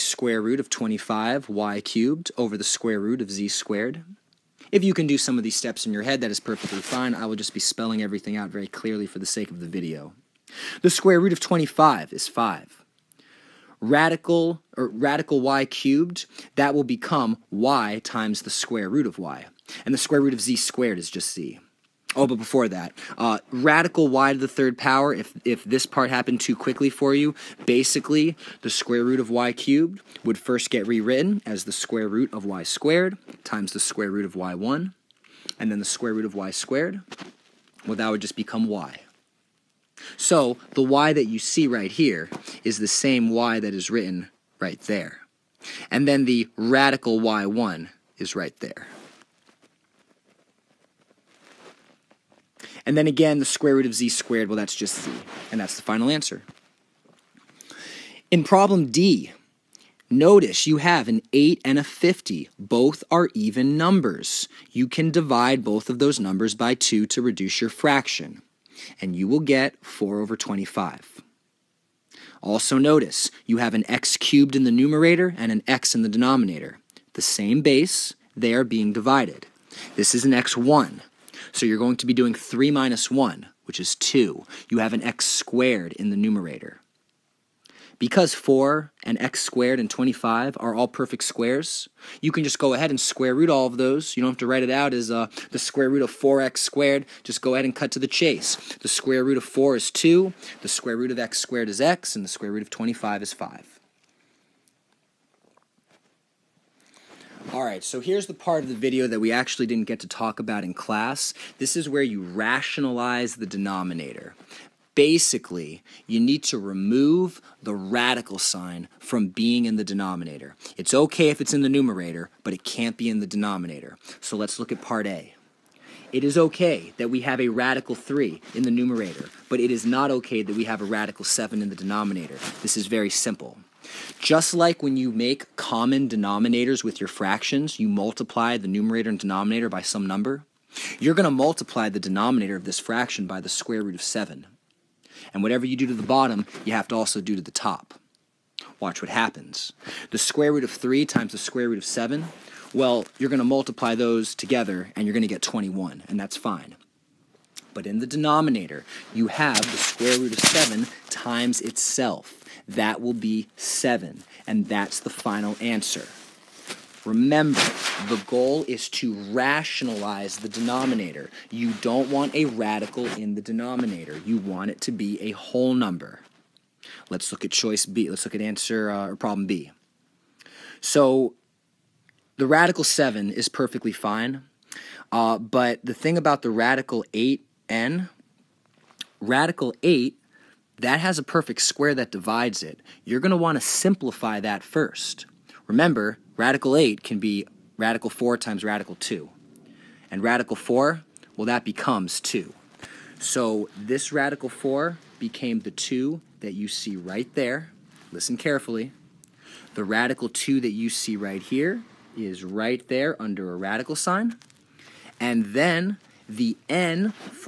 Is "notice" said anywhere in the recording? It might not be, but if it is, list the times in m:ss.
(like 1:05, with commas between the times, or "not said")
1:00, 1:12.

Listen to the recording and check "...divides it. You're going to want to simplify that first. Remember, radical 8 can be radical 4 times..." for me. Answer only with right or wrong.
right.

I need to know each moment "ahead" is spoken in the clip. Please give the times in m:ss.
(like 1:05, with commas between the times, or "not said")
1:32, 1:37.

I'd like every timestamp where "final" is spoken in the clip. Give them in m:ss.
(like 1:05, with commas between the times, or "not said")
0:55, 2:45.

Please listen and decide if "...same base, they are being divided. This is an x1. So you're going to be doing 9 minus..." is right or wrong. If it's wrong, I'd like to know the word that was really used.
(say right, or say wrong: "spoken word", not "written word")
wrong: "3", not "9".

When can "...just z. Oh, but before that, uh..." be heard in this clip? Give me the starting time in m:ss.
0:21.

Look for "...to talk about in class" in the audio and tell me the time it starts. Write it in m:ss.
1:50.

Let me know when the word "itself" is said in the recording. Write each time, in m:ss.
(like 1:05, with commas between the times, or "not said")
2:41.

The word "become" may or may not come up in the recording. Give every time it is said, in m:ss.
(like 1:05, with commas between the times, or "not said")
0:16, 0:38, 3:21.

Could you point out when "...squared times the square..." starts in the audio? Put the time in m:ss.
0:32.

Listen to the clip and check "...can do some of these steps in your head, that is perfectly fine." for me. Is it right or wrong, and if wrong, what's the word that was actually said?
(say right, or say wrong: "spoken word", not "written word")
right.